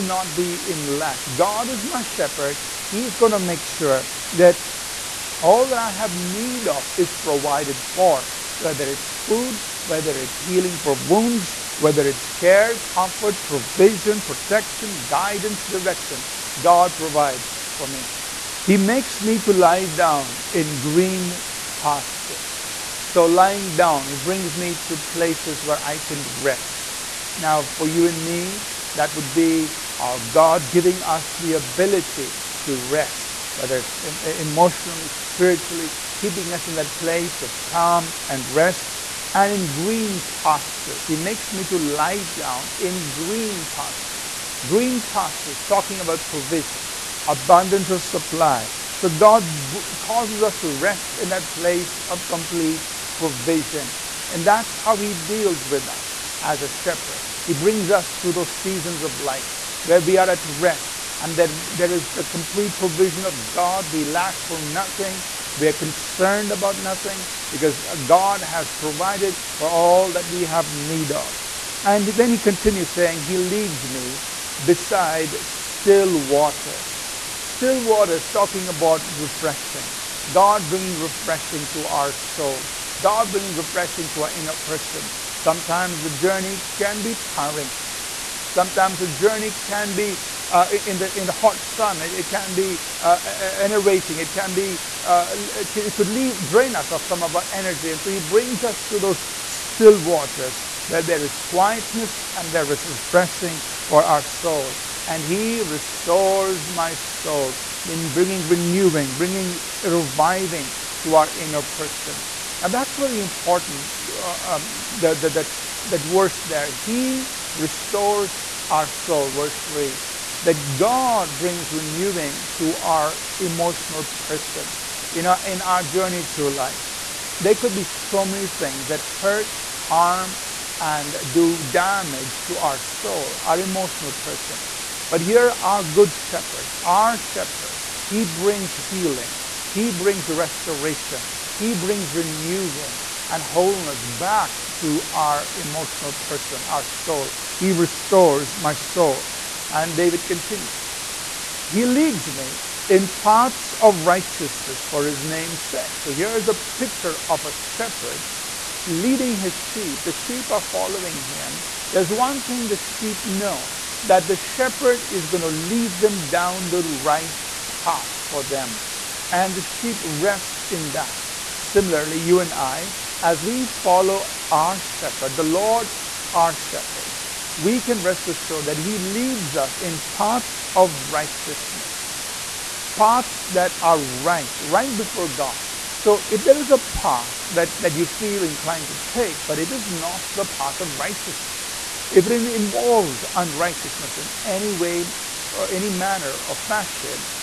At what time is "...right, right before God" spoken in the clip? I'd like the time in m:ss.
3:03.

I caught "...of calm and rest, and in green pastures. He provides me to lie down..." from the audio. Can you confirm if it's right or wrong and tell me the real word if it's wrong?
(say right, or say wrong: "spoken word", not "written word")
wrong: "makes", not "provides".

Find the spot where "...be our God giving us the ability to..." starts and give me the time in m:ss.
0:29.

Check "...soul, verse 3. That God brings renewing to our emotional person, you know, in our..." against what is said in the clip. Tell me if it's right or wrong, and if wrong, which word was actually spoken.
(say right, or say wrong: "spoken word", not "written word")
right.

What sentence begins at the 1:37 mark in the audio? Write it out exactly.
And so he brings us to those still waters where there is quietness and there is refreshing for our soul.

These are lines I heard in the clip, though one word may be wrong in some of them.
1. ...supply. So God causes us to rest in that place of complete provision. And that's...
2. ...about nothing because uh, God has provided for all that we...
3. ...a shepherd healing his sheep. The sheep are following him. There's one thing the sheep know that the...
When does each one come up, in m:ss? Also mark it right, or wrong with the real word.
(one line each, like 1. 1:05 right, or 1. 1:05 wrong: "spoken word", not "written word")
1. 0:48 right
2. 1:06 right
3. 2:37 wrong: "leading", not "healing".